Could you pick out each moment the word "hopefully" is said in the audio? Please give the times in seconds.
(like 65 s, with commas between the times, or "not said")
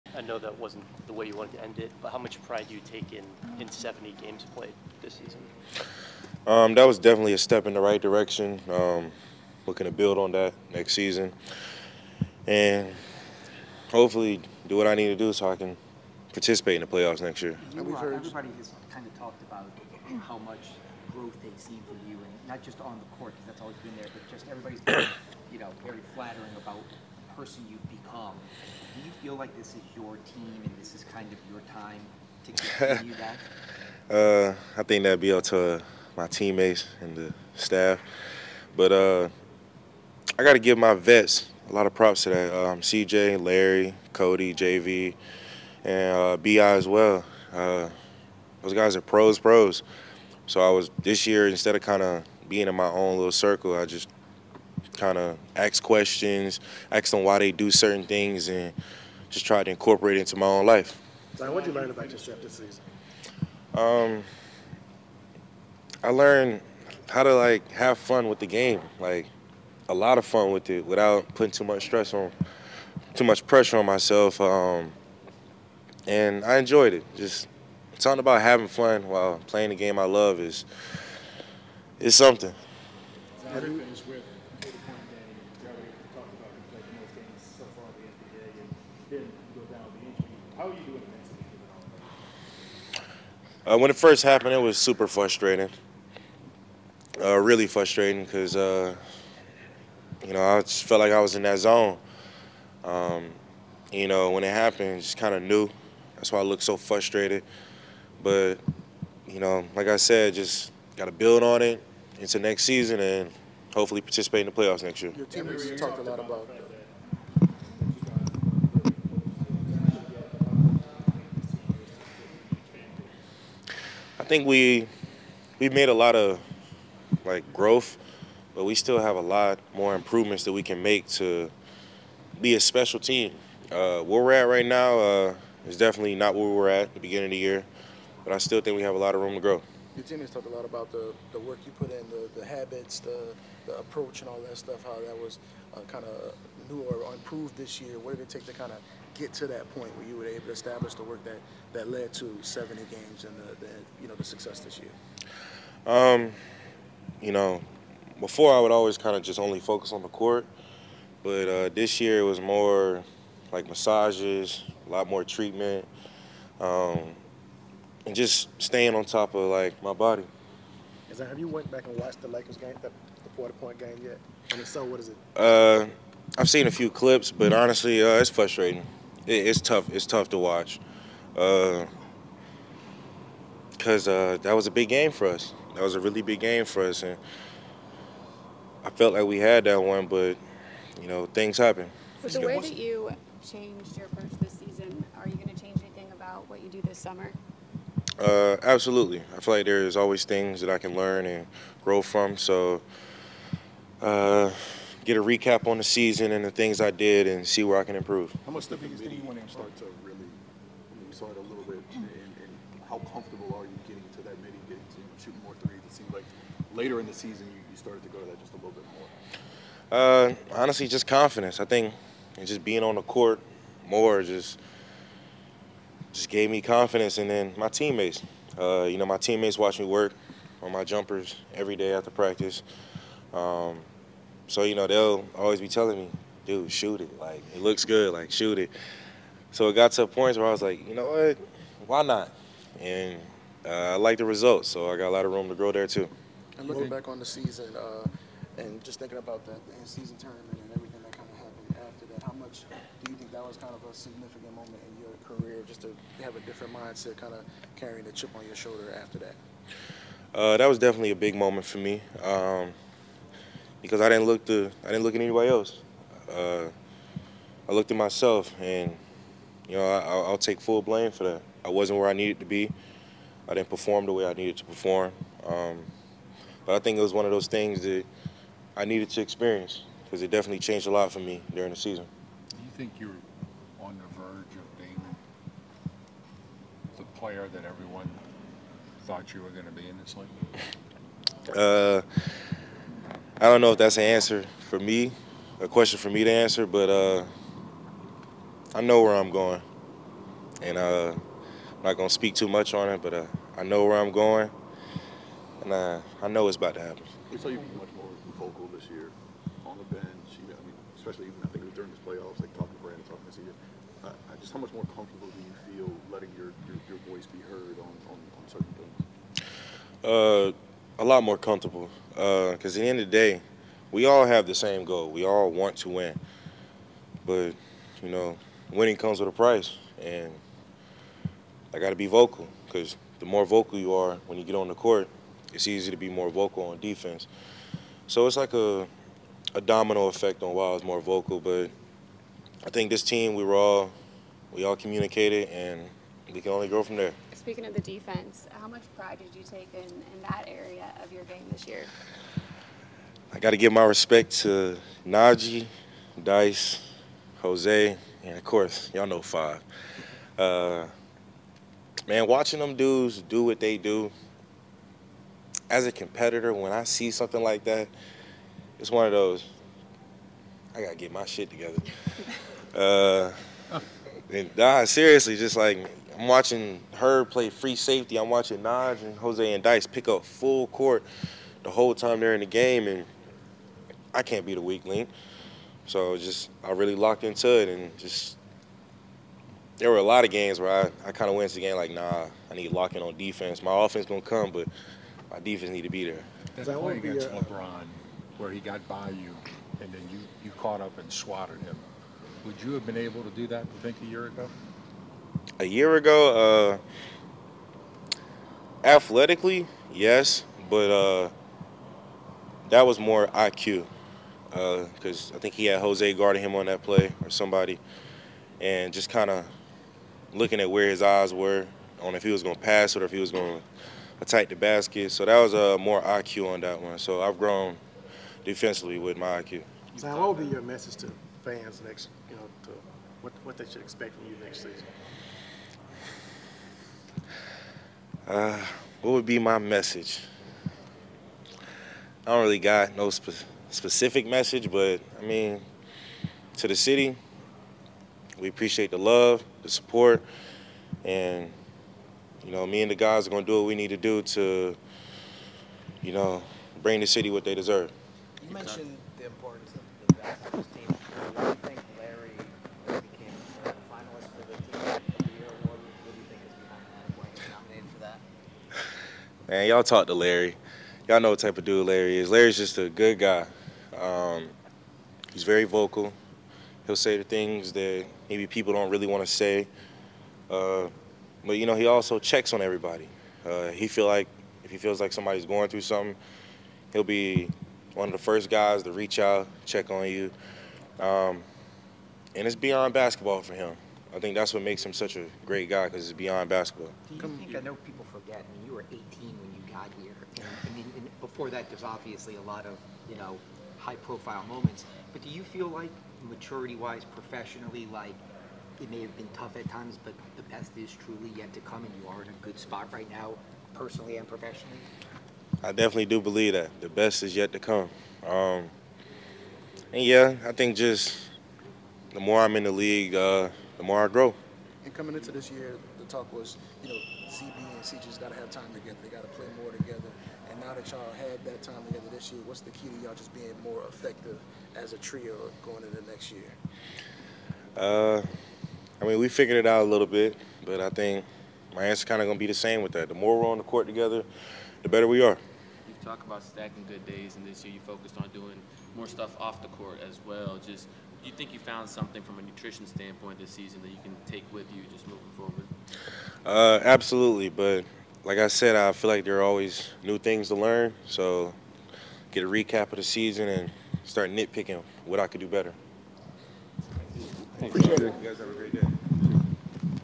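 13 s, 113 s.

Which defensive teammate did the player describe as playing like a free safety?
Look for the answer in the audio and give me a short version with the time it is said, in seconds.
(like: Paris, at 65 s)
Herb, at 376 s.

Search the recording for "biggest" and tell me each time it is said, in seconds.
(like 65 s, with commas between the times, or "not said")
208 s.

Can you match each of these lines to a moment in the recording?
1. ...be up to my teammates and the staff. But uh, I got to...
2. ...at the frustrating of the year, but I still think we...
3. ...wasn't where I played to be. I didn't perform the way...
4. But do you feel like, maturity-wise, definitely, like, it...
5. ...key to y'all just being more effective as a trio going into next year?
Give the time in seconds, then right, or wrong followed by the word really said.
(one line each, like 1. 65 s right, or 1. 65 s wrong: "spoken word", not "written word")
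1. 35 s right
2. 136 s wrong: "beginning", not "frustrating"
3. 271 s wrong: "needed", not "played"
4. 505 s wrong: "professionally", not "definitely"
5. 532 s right.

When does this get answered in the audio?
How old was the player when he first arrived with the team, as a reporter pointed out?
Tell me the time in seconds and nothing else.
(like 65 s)
499 s.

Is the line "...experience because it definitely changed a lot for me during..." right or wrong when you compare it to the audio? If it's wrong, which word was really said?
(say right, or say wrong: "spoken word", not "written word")
right.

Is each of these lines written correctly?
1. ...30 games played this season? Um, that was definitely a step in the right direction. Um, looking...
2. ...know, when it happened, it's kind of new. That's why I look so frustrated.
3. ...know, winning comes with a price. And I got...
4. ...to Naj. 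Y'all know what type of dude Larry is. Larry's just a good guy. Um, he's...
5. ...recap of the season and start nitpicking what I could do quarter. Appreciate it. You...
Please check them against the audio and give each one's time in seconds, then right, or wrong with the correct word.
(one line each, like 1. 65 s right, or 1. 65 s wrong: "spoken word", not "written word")
1. 3 s wrong: "70", not "30"
2. 104 s right
3. 328 s right
4. 470 s wrong: "Larry", not "Naj"
5. 562 s wrong: "better", not "quarter".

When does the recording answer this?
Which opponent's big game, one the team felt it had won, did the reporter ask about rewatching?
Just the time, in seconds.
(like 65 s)
172 s.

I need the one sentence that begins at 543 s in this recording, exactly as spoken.
The more we're on the court together, the better we are.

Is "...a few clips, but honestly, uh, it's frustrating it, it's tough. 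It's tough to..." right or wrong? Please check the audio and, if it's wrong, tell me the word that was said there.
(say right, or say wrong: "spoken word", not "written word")
right.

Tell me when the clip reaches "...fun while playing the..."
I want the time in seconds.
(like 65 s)
78 s.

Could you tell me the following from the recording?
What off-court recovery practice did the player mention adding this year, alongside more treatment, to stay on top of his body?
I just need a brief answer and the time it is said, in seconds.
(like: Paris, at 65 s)
massages, at 163 s.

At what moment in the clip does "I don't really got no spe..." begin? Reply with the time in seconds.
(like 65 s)
442 s.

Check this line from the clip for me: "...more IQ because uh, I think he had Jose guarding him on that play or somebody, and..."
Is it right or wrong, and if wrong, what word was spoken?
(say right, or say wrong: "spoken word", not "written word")
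right.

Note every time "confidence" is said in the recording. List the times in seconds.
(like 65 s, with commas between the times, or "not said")
221 s, 226 s.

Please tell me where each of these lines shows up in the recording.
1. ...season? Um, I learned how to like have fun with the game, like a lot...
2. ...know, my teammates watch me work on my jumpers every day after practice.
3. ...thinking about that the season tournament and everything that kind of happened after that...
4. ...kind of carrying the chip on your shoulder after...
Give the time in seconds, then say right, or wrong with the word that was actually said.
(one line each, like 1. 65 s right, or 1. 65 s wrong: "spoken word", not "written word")
1. 62 s right
2. 228 s right
3. 248 s right
4. 257 s right.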